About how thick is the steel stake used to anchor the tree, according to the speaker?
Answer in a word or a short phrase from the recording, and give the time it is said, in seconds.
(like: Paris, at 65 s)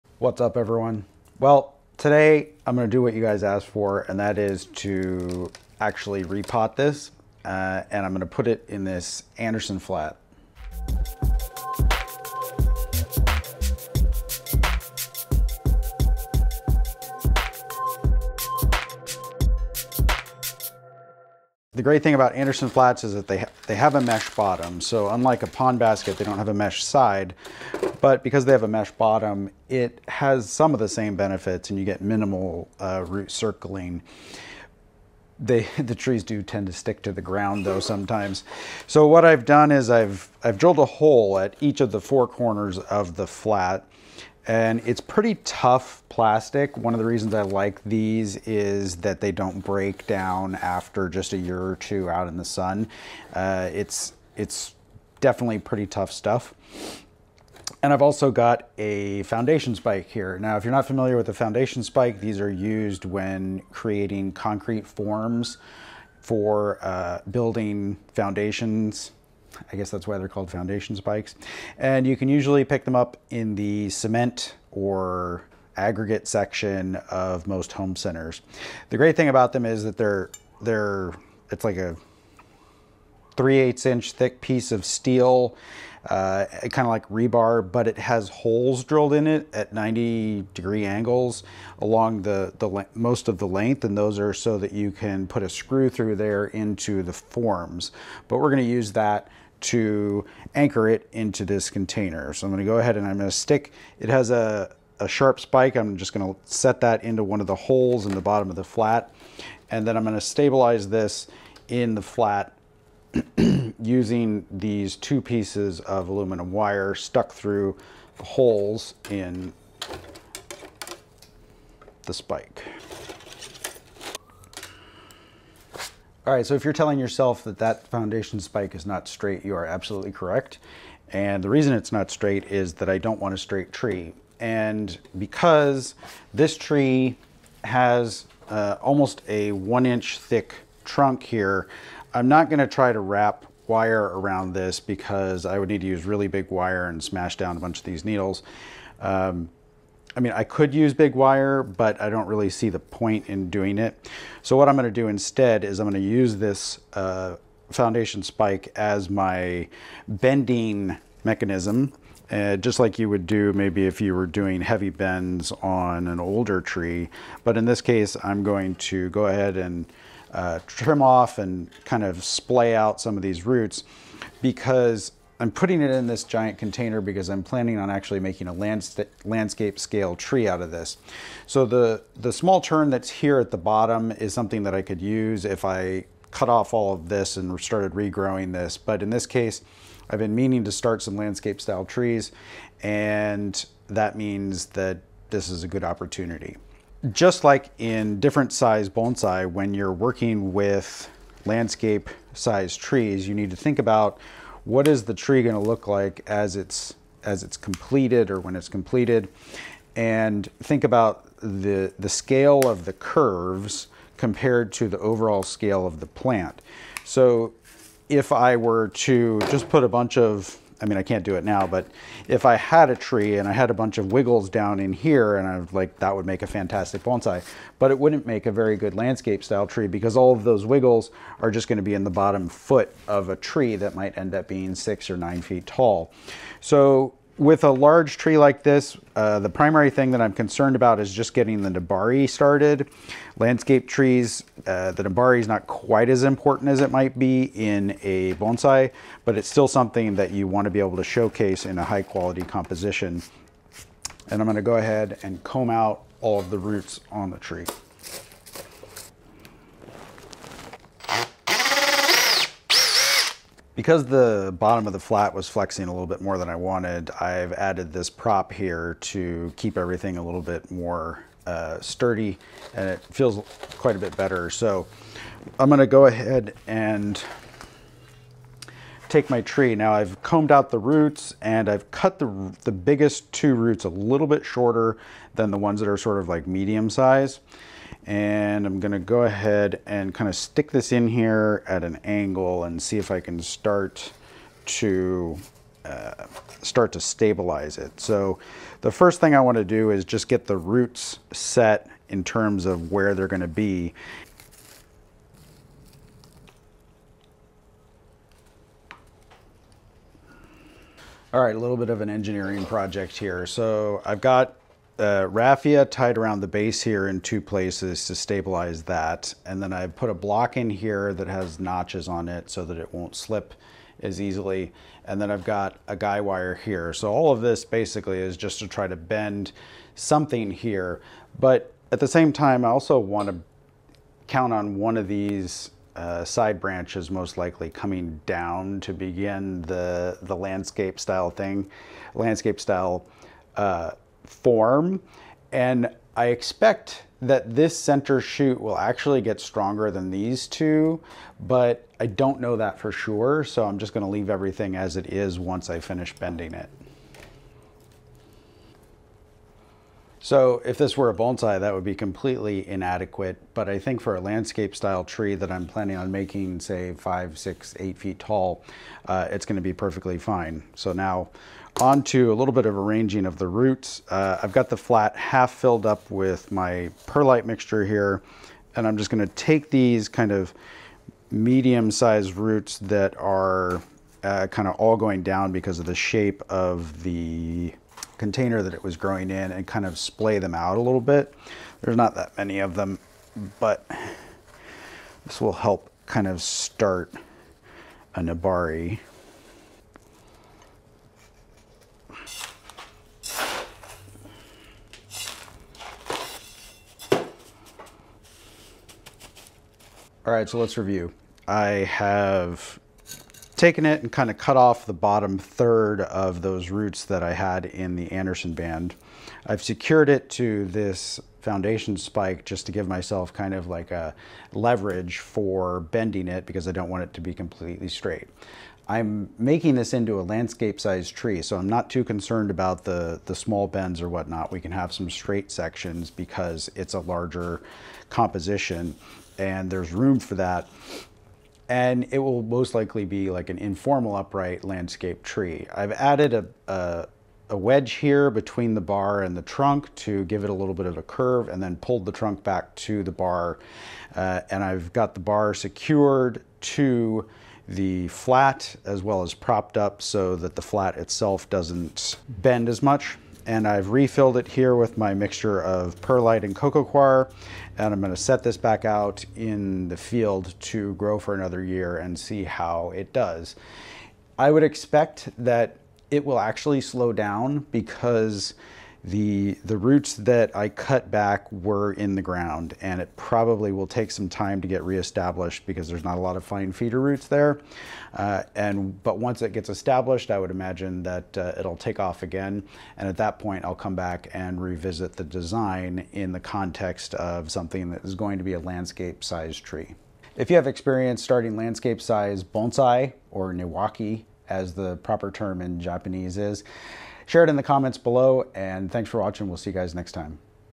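3/8 inch, at 83 s.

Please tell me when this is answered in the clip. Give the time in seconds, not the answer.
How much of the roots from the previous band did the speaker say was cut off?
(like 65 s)
414 s.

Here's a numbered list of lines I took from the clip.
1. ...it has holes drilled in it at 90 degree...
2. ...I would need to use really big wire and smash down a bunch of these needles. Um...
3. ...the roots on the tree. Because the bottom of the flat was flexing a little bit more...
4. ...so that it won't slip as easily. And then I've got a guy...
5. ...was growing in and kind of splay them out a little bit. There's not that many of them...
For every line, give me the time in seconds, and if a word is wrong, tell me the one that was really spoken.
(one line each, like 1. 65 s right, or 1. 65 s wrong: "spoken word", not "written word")
1. 87 s right
2. 145 s right
3. 256 s right
4. 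322 s right
5. 388 s right.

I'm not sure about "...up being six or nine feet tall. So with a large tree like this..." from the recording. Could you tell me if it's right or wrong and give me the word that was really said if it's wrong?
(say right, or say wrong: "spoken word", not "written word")
right.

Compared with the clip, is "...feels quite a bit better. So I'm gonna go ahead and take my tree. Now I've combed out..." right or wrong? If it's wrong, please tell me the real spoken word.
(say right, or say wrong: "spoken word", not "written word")
right.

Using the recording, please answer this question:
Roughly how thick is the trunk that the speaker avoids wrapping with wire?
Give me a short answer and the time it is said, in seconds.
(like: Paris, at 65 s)
1 inch, at 139 s.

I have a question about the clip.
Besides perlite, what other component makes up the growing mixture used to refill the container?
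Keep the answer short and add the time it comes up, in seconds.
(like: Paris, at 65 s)
cocoa coir, at 466 s.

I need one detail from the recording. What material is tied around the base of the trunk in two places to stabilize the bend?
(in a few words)
raffia.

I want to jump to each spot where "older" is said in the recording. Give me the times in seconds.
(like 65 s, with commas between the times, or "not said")
166 s.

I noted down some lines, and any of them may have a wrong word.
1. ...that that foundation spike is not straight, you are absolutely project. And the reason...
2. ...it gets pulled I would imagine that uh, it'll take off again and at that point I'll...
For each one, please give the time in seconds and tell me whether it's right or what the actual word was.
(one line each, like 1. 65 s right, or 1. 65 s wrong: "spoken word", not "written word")
1. 127 s wrong: "correct", not "project"
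2. 489 s wrong: "established", not "pulled".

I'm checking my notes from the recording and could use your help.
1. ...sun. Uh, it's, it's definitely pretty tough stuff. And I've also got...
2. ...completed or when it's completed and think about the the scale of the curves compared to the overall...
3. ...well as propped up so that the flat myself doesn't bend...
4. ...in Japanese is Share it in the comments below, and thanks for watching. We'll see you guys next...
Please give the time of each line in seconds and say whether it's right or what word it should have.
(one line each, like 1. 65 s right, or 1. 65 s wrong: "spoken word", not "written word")
1. 52 s right
2. 207 s right
3. 459 s wrong: "itself", not "myself"
4. 505 s right.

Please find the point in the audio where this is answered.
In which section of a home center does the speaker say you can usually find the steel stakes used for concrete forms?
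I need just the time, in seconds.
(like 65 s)
73 s.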